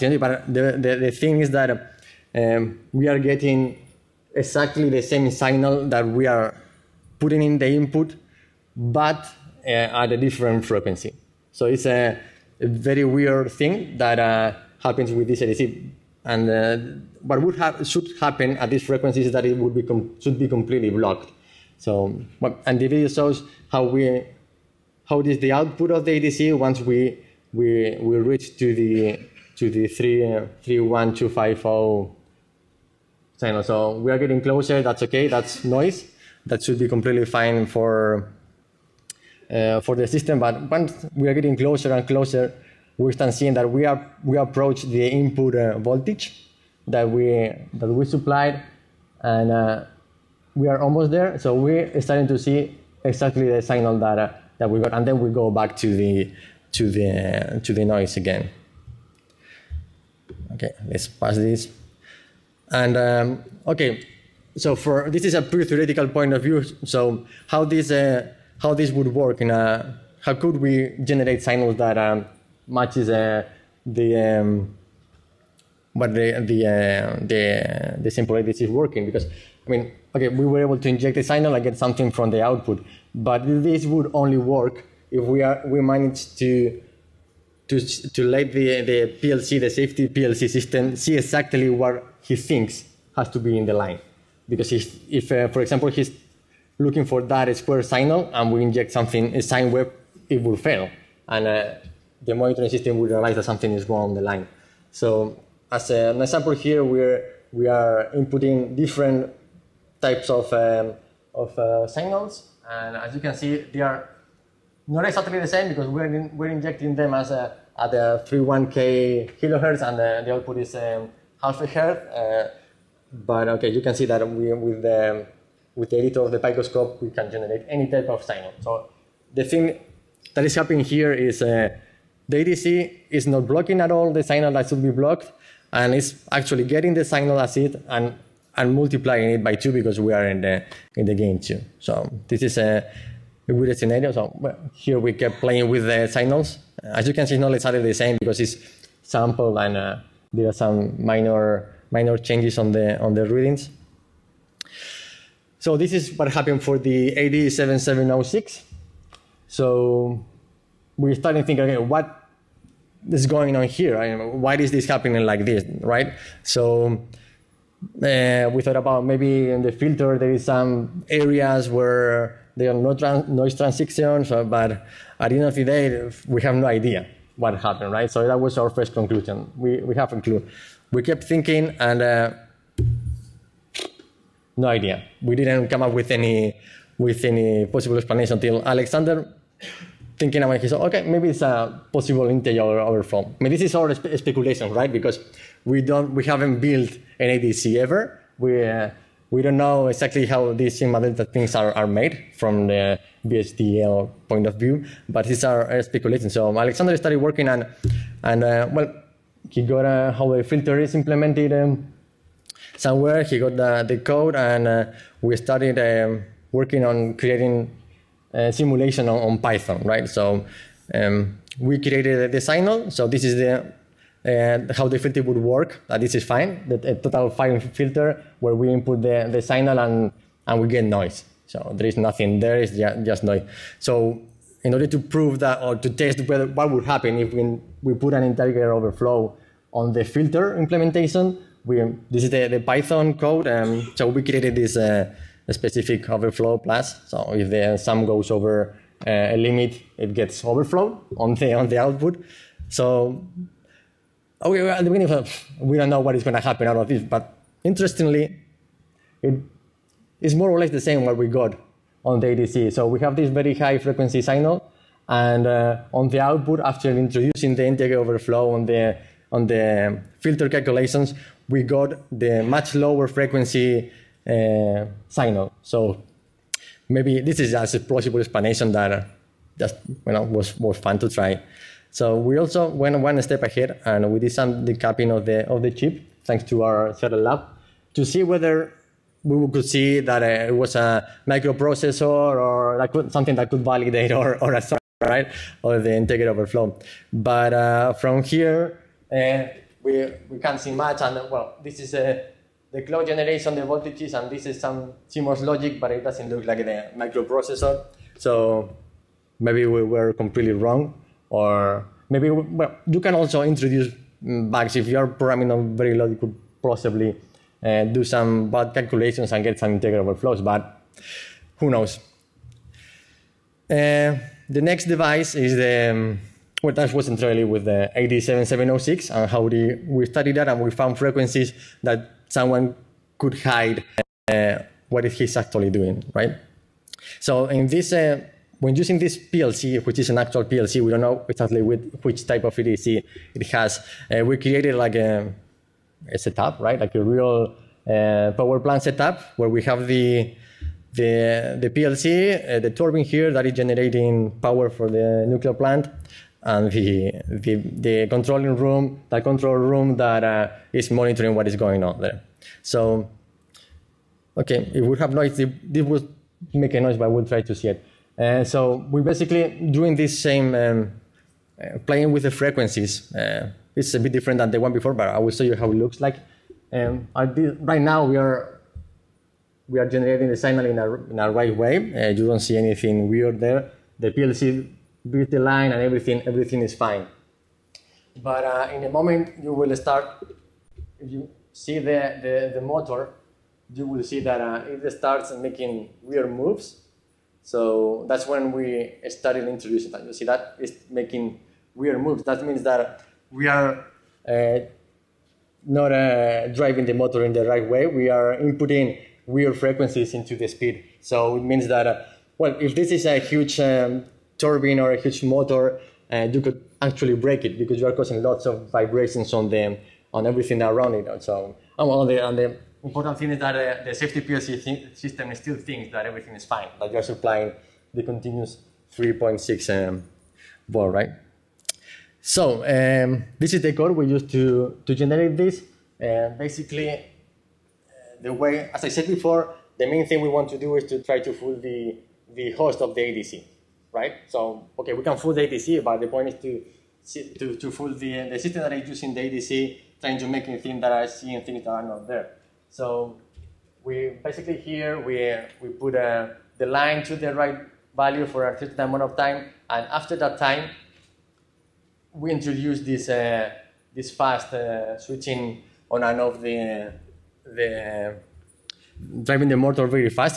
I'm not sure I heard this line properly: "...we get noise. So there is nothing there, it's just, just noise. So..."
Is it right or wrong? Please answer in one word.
right.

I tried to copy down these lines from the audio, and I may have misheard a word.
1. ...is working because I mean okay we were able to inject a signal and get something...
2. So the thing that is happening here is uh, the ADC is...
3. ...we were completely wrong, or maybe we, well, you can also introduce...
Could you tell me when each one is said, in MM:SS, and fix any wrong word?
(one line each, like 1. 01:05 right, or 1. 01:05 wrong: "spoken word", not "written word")
1. 01:18 right
2. 02:08 right
3. 05:09 right.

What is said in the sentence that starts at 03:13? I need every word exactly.
I mean, this is all spe speculation, right?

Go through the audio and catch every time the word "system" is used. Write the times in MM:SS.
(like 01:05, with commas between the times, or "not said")
00:40, 01:30, 01:42, 07:04, 07:28.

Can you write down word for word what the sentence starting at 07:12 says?
So um, this is the code we used to, to generate this.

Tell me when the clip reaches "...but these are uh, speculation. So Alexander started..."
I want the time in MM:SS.
03:25.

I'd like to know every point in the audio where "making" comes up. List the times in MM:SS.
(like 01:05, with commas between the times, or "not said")
06:35, 06:40.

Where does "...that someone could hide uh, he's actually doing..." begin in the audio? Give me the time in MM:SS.
05:31.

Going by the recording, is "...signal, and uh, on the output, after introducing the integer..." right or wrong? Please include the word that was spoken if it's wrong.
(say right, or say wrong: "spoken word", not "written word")
right.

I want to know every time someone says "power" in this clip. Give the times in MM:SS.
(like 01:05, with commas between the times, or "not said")
05:48, 05:54.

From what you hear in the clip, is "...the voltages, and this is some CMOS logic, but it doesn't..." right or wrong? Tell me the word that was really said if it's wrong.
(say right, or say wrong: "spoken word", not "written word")
right.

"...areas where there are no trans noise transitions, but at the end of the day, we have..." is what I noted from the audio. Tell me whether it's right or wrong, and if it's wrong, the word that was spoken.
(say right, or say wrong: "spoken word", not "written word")
right.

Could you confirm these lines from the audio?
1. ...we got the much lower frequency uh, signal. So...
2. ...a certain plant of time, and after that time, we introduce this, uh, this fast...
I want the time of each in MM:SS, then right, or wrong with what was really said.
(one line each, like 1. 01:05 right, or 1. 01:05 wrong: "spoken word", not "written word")
1. 04:31 right
2. 07:38 wrong: "amount", not "plant".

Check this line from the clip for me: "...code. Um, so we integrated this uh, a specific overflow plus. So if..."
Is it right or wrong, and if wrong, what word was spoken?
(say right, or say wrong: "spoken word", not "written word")
wrong: "created", not "integrated".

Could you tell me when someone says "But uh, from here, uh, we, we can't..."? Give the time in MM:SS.
04:57.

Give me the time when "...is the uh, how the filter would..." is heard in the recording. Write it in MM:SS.
03:43.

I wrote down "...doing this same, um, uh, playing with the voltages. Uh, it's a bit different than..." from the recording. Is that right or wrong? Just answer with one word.
wrong.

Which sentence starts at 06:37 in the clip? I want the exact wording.
So that's when we started introducing that.